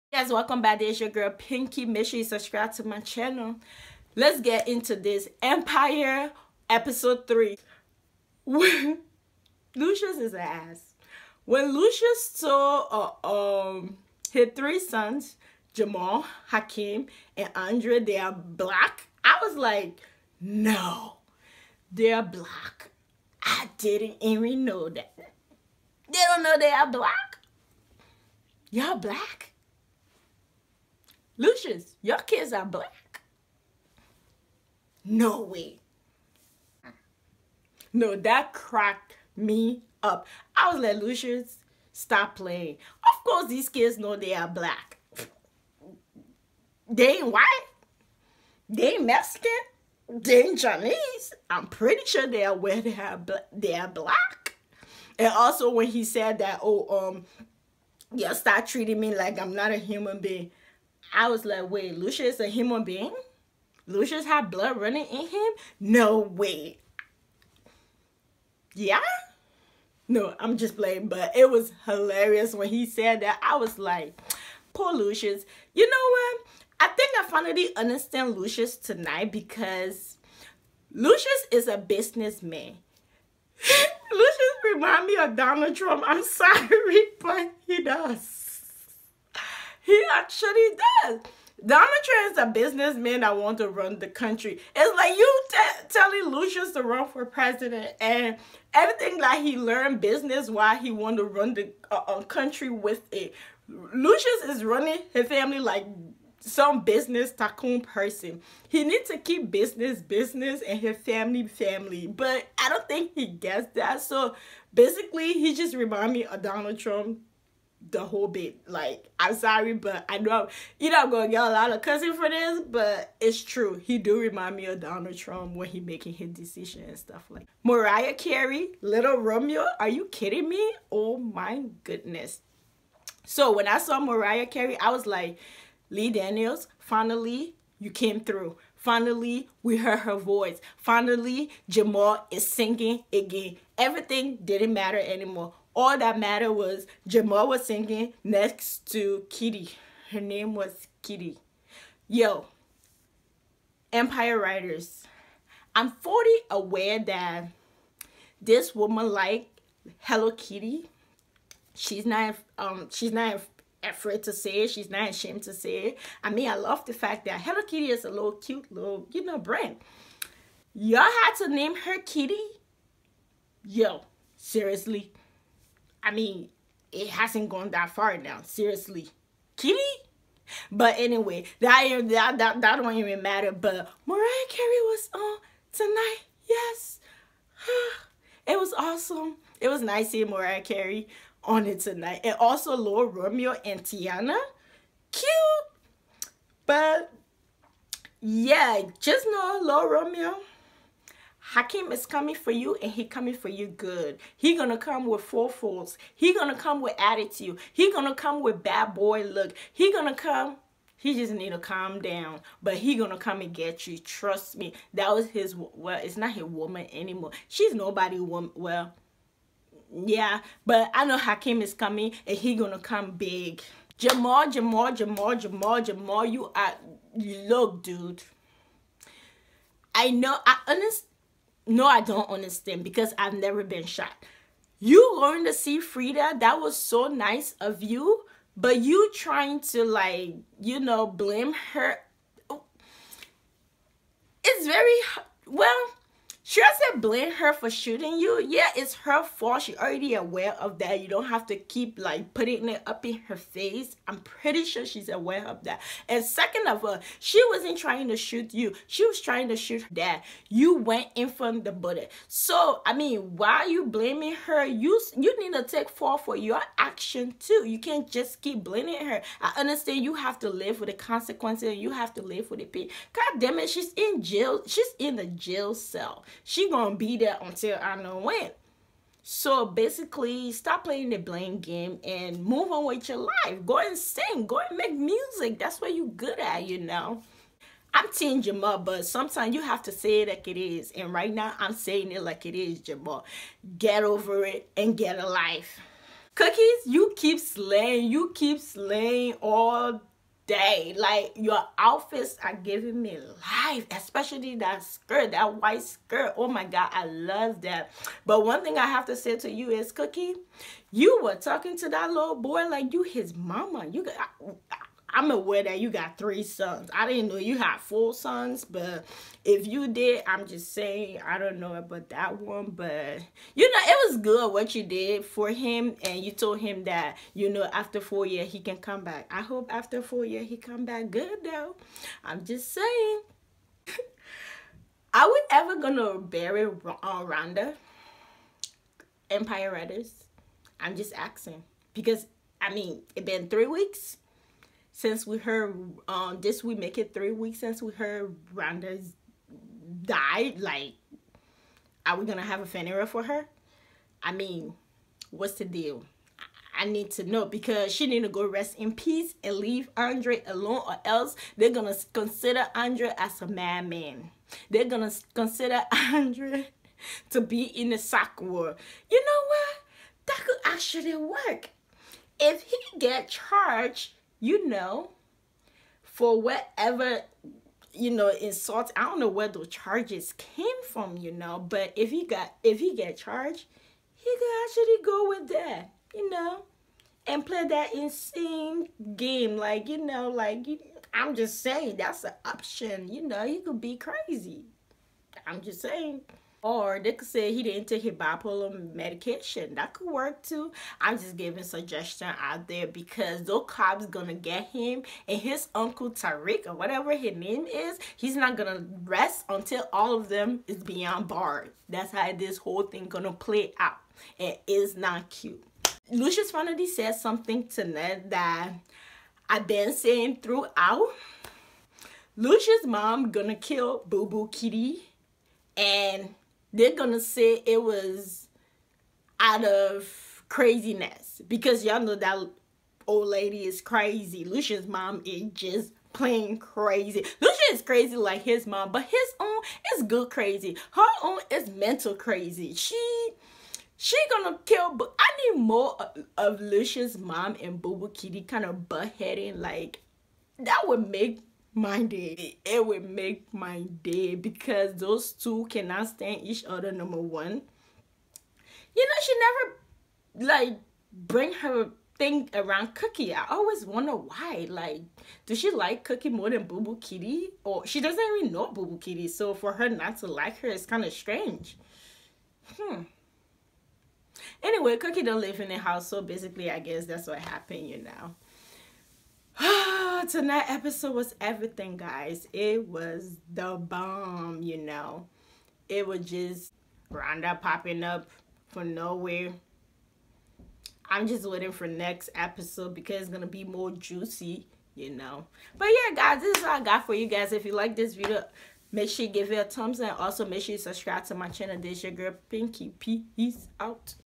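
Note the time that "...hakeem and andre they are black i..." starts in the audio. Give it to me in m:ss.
0:16.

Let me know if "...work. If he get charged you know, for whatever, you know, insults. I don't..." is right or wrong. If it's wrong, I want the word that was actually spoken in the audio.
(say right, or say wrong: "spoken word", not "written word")
right.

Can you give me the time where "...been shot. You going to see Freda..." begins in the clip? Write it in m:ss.
3:53.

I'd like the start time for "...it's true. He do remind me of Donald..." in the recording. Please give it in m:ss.
2:03.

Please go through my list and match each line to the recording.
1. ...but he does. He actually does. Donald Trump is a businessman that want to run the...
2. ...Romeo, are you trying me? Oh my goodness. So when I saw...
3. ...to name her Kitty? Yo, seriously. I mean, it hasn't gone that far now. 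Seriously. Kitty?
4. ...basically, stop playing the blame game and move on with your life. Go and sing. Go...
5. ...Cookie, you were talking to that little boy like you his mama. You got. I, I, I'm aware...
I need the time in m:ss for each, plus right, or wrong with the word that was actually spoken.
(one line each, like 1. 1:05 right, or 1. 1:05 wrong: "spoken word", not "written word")
1. 1:27 right
2. 2:09 wrong: "kidding", not "trying"
3. 2:51 right
4. 4:39 right
5. 5:09 right.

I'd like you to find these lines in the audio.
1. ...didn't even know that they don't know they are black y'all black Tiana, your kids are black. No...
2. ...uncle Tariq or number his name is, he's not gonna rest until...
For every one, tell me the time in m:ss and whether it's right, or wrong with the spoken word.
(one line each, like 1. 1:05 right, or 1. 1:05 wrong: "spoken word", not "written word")
1. 0:23 wrong: "Lucious", not "Tiana"
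2. 6:45 wrong: "whatever", not "number".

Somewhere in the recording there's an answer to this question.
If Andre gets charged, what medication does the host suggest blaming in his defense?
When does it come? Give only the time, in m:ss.
6:38.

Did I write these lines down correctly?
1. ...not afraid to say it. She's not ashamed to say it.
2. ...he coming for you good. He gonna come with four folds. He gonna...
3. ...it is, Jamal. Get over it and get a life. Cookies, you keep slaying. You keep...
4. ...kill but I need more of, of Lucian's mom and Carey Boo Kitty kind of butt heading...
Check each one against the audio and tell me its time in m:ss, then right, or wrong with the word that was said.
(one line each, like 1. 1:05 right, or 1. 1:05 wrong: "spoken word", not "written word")
1. 2:43 right
2. 3:22 right
3. 4:52 right
4. 7:24 wrong: "Boo", not "Carey".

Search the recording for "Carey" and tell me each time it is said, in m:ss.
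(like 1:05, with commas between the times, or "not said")
2:08, 2:14, 3:04, 3:10.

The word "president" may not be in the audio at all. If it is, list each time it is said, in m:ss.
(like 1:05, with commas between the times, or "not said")
1:37.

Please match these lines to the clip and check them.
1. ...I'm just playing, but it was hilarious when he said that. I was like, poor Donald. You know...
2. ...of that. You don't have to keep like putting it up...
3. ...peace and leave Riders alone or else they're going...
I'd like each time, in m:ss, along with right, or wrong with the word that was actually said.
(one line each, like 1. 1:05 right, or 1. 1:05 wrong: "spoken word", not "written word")
1. 1:10 wrong: "Lucious", not "Donald"
2. 4:10 right
3. 5:58 wrong: "Andre", not "Riders".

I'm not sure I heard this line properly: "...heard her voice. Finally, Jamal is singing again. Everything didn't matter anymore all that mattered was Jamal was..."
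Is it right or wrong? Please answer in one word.
right.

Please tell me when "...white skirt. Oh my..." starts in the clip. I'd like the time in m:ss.
5:05.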